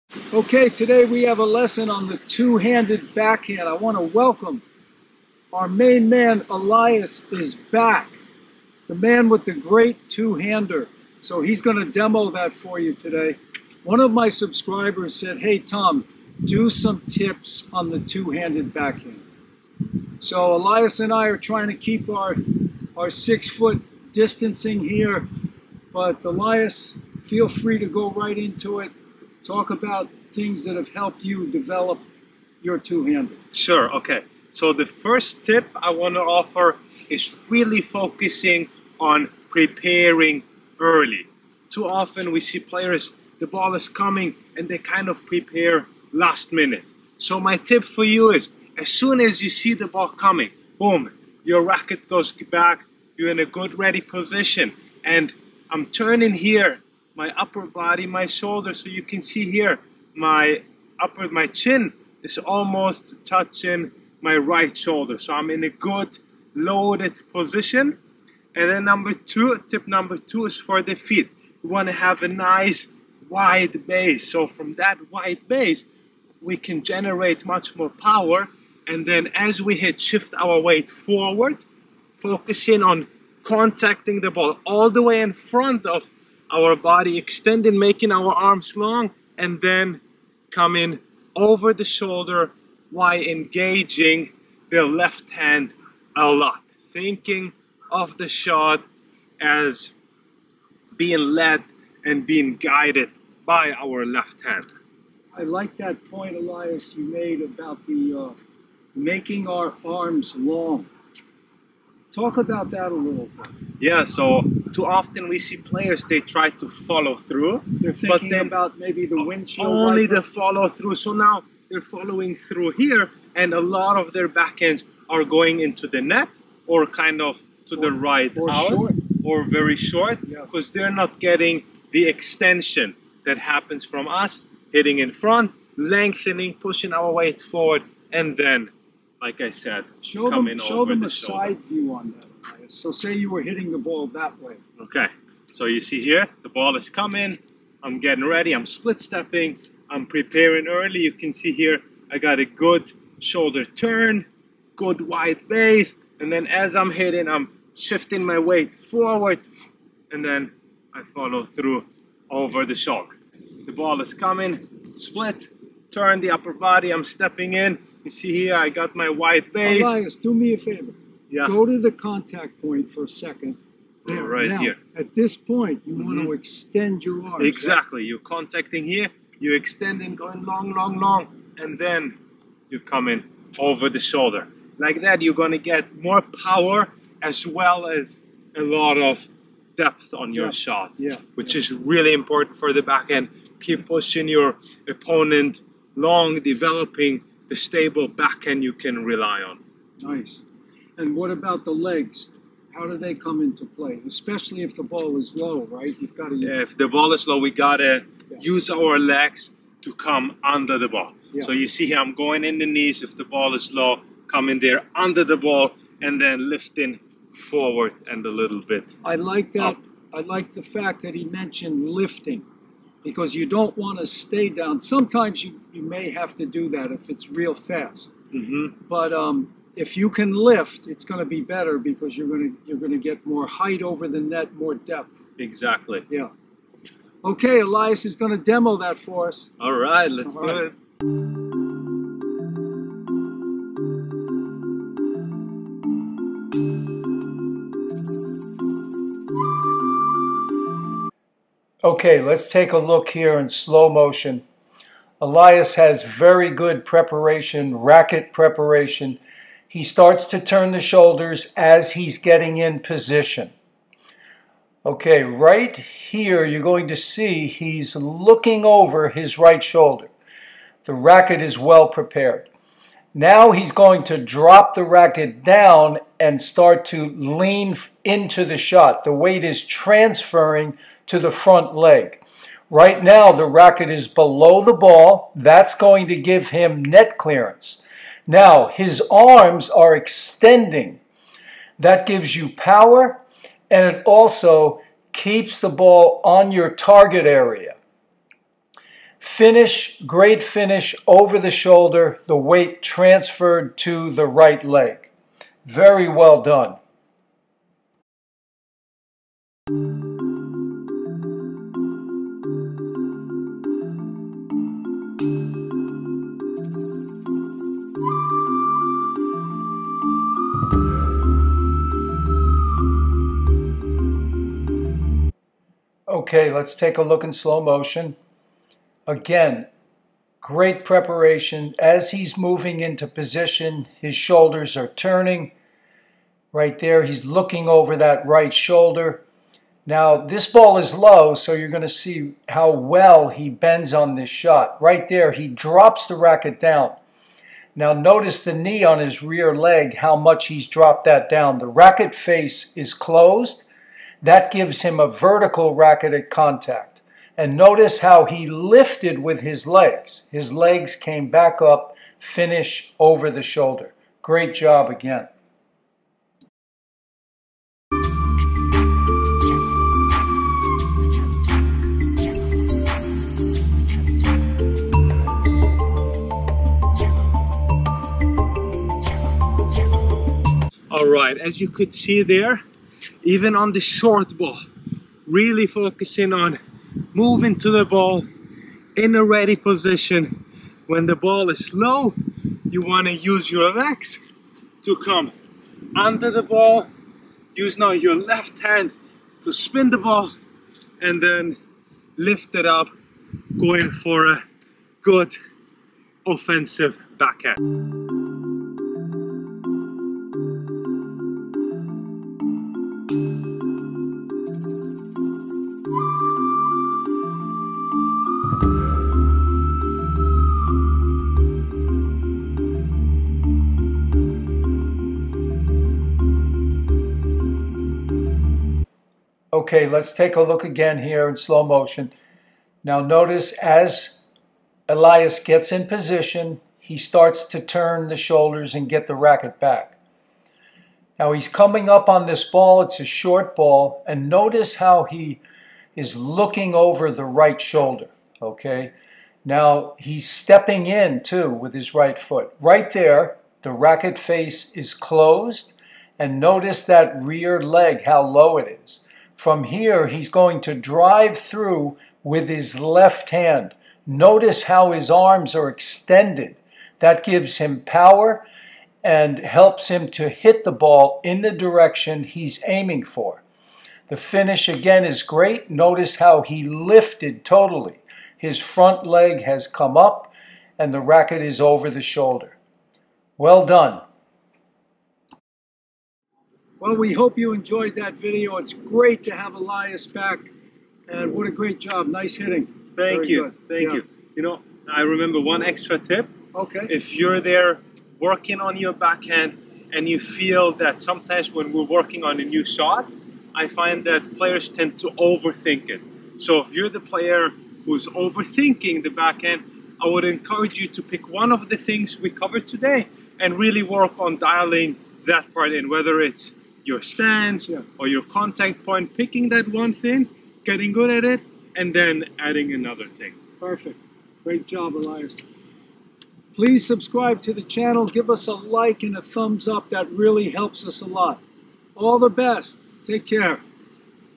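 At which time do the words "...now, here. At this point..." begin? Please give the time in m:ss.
2:54.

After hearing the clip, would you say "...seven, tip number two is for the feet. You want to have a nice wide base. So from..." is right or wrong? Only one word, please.
wrong.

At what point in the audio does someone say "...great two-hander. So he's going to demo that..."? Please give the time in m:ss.
0:09.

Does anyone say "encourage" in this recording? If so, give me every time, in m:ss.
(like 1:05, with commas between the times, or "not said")
8:30.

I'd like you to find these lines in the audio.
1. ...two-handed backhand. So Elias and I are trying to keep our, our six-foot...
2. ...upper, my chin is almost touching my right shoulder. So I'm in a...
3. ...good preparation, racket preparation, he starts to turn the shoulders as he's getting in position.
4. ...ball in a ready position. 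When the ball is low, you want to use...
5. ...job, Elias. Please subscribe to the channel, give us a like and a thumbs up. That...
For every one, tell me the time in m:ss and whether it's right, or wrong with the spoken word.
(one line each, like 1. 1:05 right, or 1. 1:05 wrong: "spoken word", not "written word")
1. 0:18 right
2. 1:00 right
3. 4:16 right
4. 6:27 right
5. 8:44 right.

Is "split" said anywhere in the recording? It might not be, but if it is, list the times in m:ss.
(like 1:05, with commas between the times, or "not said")
2:28, 2:44.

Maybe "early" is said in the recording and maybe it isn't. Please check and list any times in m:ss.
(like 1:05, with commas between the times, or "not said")
0:40, 2:30.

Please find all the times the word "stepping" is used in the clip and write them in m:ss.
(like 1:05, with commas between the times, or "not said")
2:29, 2:47, 7:30.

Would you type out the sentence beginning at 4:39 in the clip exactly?
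The weight is transferring to the front leg.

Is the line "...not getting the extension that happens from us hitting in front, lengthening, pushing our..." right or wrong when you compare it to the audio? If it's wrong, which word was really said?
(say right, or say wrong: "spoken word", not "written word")
right.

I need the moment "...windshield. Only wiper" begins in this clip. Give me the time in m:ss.
1:59.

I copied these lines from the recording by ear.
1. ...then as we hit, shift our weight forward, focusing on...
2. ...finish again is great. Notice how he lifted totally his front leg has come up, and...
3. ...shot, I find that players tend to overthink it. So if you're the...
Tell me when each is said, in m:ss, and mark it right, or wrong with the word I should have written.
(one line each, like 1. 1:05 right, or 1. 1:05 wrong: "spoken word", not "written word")
1. 1:19 right
2. 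7:54 right
3. 8:22 right.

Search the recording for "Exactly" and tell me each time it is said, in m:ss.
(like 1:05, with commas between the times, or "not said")
2:57, 3:55.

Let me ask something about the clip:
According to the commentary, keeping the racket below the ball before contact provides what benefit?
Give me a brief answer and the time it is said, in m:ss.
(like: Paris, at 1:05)
net clearance, at 4:46.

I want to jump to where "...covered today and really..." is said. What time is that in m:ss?
8:32.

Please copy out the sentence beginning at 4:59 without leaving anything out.
Finish, great finish over the shoulder, the weight transferred to the right leg.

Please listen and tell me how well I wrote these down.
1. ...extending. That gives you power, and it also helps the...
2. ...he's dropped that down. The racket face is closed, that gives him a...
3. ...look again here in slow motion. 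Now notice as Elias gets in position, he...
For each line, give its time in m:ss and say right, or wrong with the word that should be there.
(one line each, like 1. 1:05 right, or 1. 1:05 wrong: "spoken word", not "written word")
1. 4:49 wrong: "keeps", not "helps"
2. 5:50 right
3. 7:10 right.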